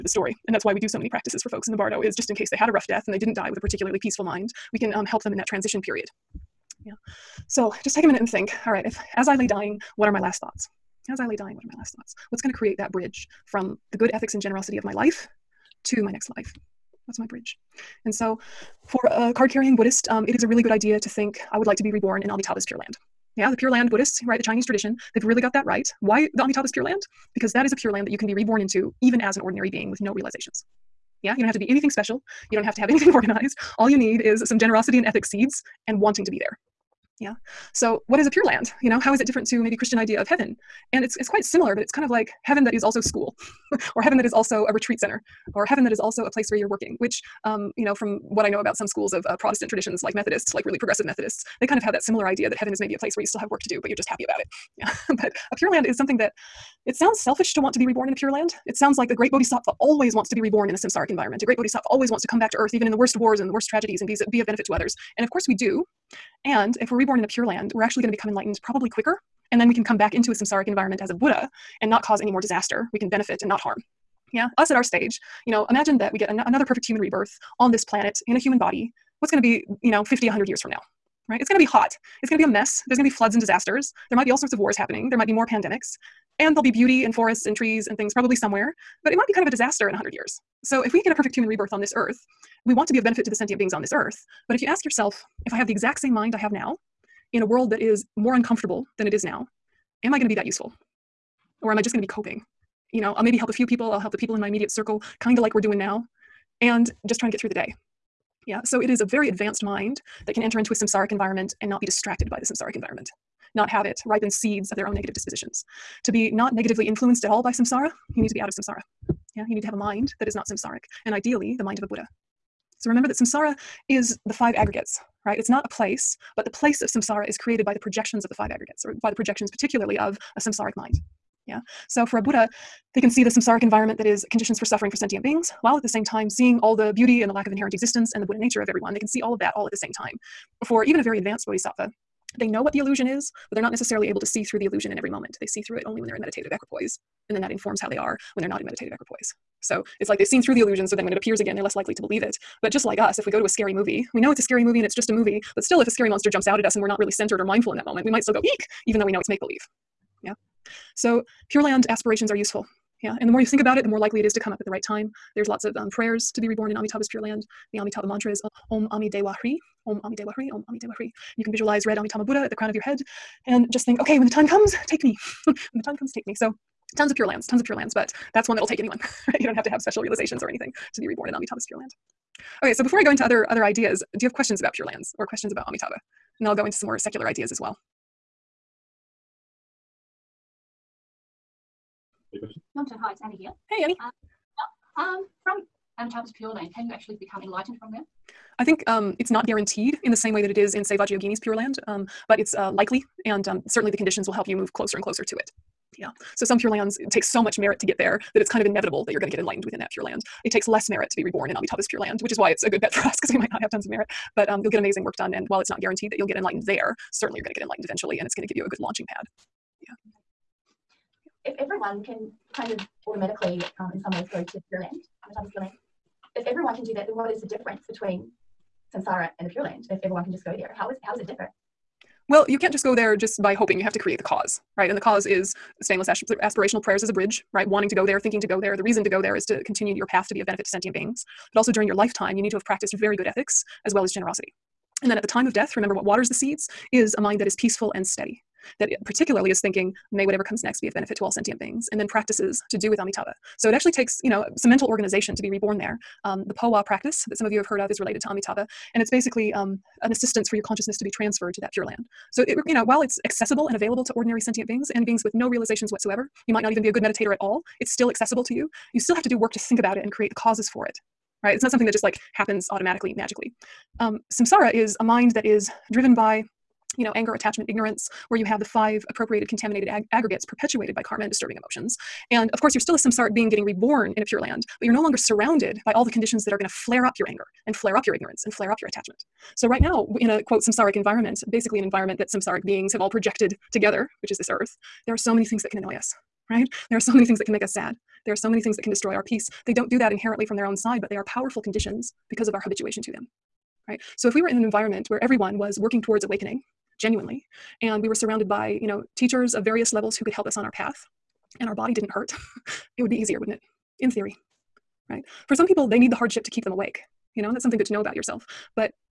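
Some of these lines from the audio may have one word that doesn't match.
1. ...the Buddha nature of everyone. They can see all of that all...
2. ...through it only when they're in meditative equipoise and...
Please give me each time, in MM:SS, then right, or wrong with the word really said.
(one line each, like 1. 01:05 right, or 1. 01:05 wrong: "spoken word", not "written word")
1. 02:18 right
2. 02:25 right.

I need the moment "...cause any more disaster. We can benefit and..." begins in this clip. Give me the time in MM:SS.
01:12.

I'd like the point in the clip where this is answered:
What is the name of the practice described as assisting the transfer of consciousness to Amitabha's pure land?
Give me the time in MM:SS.
04:16.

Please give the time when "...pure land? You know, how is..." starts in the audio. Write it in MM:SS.
00:38.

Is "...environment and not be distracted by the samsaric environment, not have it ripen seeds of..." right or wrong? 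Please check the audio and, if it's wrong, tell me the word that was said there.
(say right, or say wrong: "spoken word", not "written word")
right.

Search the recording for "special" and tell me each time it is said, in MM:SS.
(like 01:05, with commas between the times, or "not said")
00:31, 02:59.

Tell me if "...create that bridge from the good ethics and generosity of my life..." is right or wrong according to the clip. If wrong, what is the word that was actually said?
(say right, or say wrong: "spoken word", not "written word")
right.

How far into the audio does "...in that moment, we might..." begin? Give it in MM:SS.
02:37.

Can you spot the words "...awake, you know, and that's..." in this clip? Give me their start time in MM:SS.
05:16.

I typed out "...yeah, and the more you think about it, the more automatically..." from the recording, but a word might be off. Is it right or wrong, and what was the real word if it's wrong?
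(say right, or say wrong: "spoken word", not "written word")
wrong: "likely", not "automatically".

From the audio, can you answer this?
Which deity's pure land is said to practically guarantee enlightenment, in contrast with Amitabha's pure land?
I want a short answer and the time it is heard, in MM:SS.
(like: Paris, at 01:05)
Vajrayogini, at 03:20.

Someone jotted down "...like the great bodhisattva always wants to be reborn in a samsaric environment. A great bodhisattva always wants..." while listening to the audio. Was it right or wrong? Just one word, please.
right.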